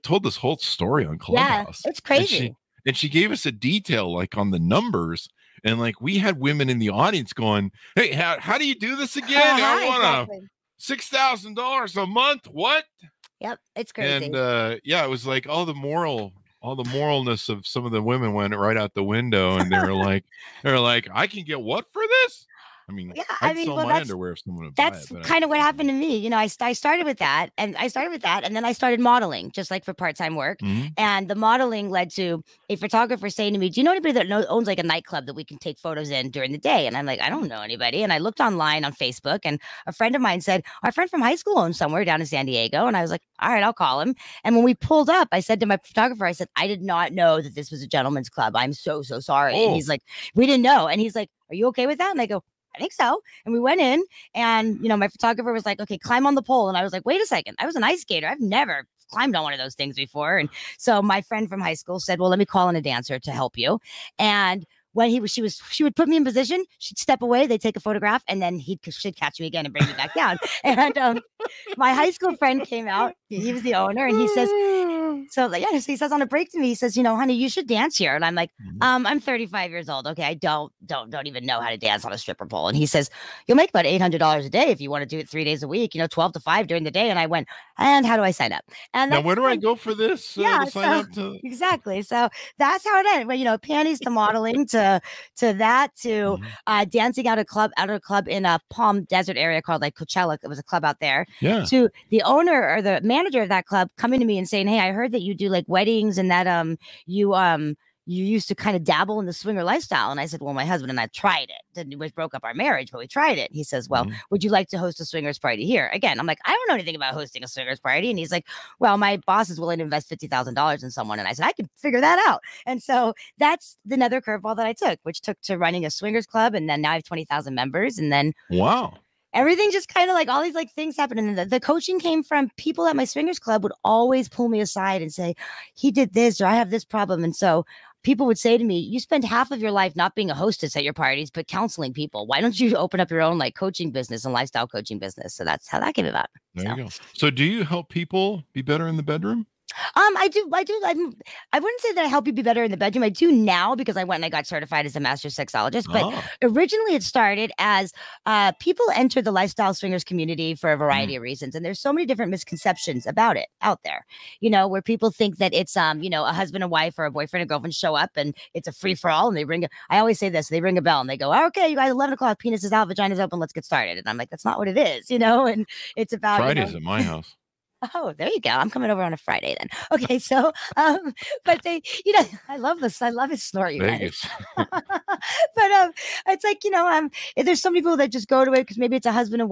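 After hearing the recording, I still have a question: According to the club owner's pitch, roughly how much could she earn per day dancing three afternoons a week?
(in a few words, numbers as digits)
$800.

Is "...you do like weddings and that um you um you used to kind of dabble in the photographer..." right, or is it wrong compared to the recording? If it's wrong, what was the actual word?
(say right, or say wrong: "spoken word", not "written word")
wrong: "swinger", not "photographer".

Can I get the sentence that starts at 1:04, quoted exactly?
And when he was, she was, she would put me in position.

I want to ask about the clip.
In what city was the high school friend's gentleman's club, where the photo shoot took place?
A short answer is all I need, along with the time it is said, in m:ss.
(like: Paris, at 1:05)
San Diego, at 0:42.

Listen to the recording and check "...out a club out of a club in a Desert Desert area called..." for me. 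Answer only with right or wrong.
wrong.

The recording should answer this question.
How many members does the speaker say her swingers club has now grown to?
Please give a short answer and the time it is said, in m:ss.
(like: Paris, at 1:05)
20,000, at 2:07.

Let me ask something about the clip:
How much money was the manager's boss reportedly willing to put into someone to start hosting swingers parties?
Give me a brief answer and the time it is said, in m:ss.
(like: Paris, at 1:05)
$50,000, at 2:00.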